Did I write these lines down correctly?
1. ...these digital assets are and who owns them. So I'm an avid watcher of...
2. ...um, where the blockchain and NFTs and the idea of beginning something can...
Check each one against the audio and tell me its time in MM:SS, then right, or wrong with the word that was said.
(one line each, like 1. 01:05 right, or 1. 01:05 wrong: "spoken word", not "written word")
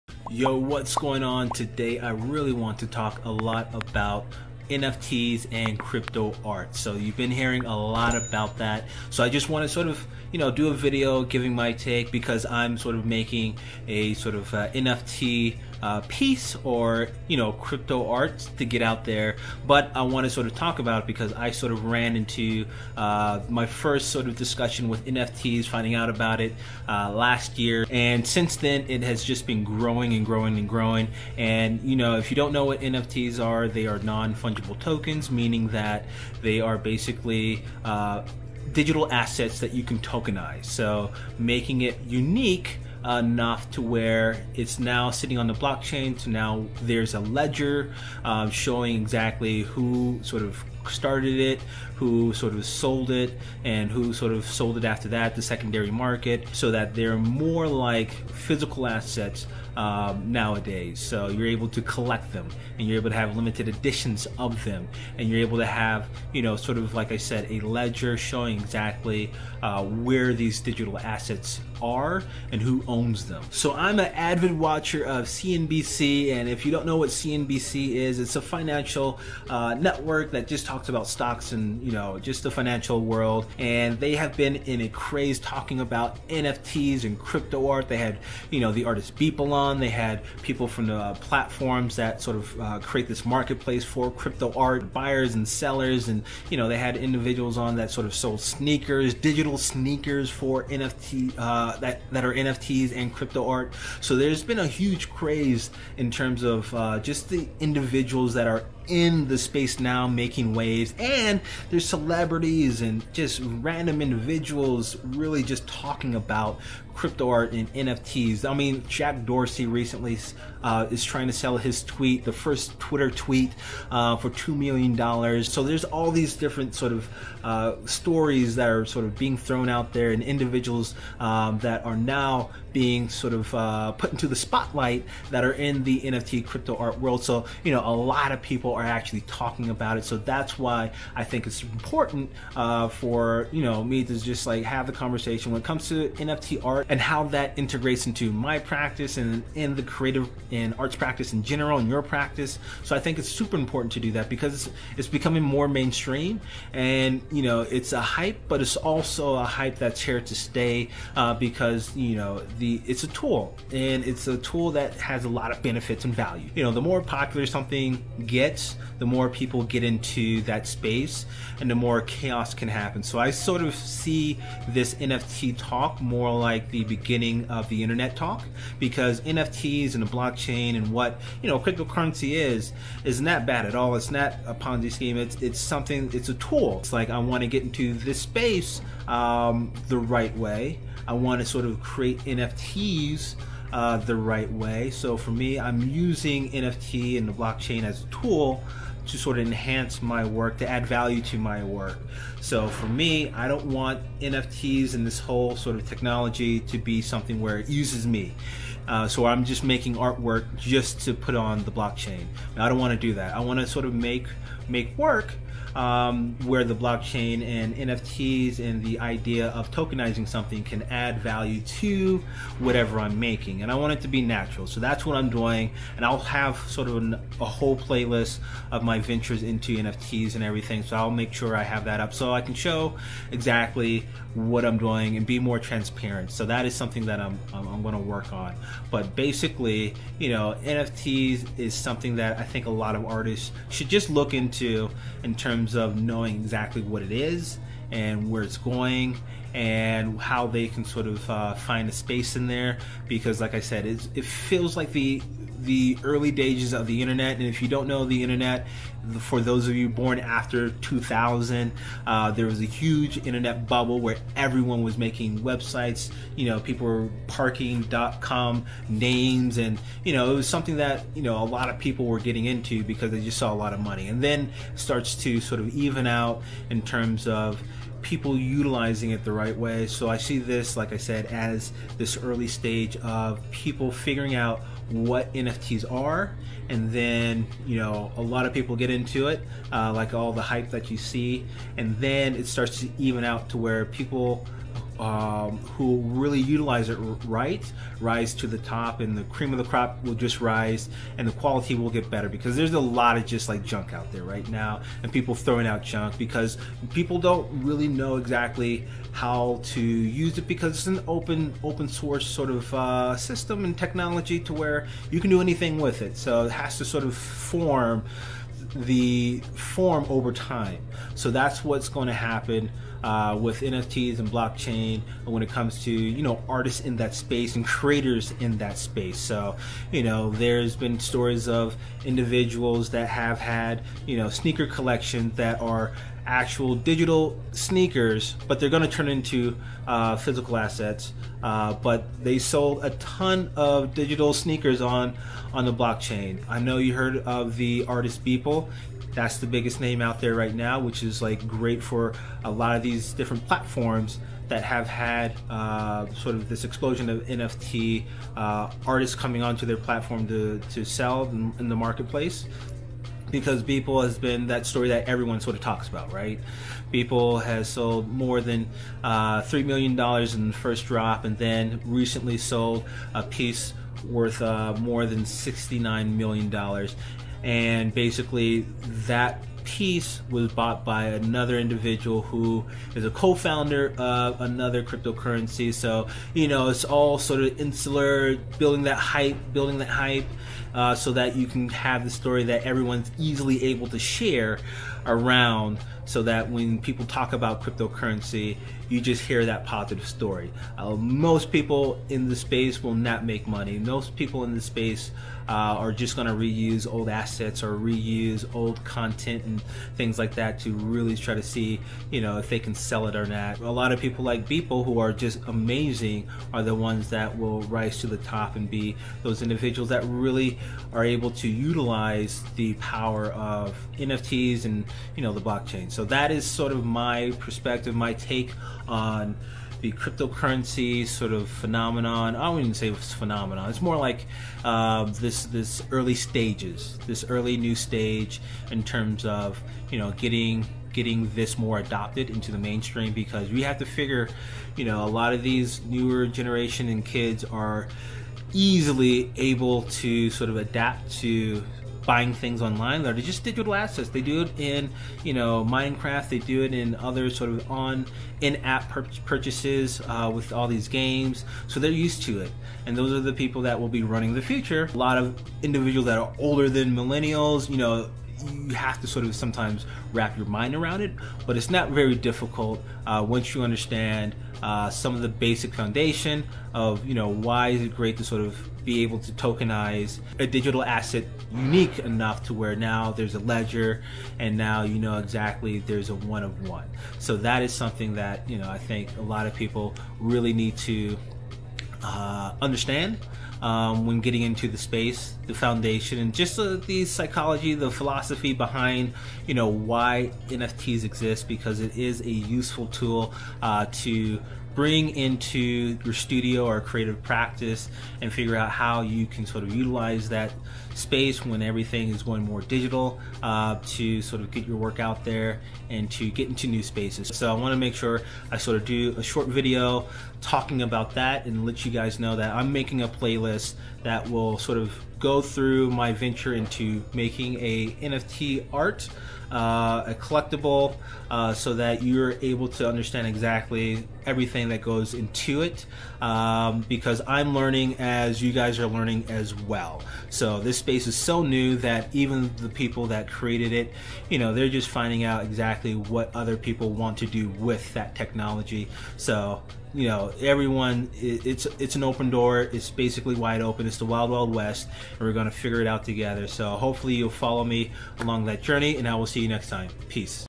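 1. 01:10 right
2. 03:35 wrong: "tokenizing", not "beginning".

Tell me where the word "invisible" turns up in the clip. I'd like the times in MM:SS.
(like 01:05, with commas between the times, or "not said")
not said.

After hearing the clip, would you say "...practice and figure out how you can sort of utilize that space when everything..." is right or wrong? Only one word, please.
right.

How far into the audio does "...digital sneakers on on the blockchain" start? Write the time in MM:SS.
05:43.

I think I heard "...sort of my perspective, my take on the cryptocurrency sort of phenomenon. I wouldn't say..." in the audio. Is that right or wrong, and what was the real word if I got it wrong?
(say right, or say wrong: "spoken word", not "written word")
right.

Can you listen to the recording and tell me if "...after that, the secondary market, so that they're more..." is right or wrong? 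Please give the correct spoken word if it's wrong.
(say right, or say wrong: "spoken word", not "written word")
right.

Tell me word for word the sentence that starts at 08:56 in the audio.
Um, because I'm learning as you guys are learning as well.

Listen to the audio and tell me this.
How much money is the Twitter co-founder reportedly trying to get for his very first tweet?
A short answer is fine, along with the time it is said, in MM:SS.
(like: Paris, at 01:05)
$2 million, at 02:04.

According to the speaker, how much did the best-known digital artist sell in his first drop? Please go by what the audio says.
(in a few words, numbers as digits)
$3 million.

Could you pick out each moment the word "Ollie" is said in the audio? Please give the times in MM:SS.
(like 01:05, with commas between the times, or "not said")
not said.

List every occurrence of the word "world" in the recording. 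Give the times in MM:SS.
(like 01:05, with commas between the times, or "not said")
01:23, 02:16.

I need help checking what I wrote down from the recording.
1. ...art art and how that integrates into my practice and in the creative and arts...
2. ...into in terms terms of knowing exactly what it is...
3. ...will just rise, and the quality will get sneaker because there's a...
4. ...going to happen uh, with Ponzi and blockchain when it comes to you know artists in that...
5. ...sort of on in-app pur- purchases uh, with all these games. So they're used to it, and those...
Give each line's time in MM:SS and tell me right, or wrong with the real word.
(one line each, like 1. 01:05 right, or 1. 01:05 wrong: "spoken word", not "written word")
1. 02:26 right
2. 04:04 right
3. 05:00 wrong: "better", not "sneaker"
4. 05:21 wrong: "NFTs", not "Ponzi"
5. 07:37 right.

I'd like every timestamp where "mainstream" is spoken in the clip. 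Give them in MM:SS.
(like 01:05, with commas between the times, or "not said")
02:35, 07:22.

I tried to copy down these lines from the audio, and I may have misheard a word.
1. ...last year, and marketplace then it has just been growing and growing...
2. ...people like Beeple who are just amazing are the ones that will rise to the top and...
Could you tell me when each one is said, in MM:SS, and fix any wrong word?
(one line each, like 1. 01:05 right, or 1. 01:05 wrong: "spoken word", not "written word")
1. 00:27 wrong: "since", not "marketplace"
2. 06:53 right.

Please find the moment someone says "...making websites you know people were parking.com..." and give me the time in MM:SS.
04:24.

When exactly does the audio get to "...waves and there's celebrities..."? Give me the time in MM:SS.
01:50.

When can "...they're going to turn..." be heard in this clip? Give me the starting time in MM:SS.
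05:38.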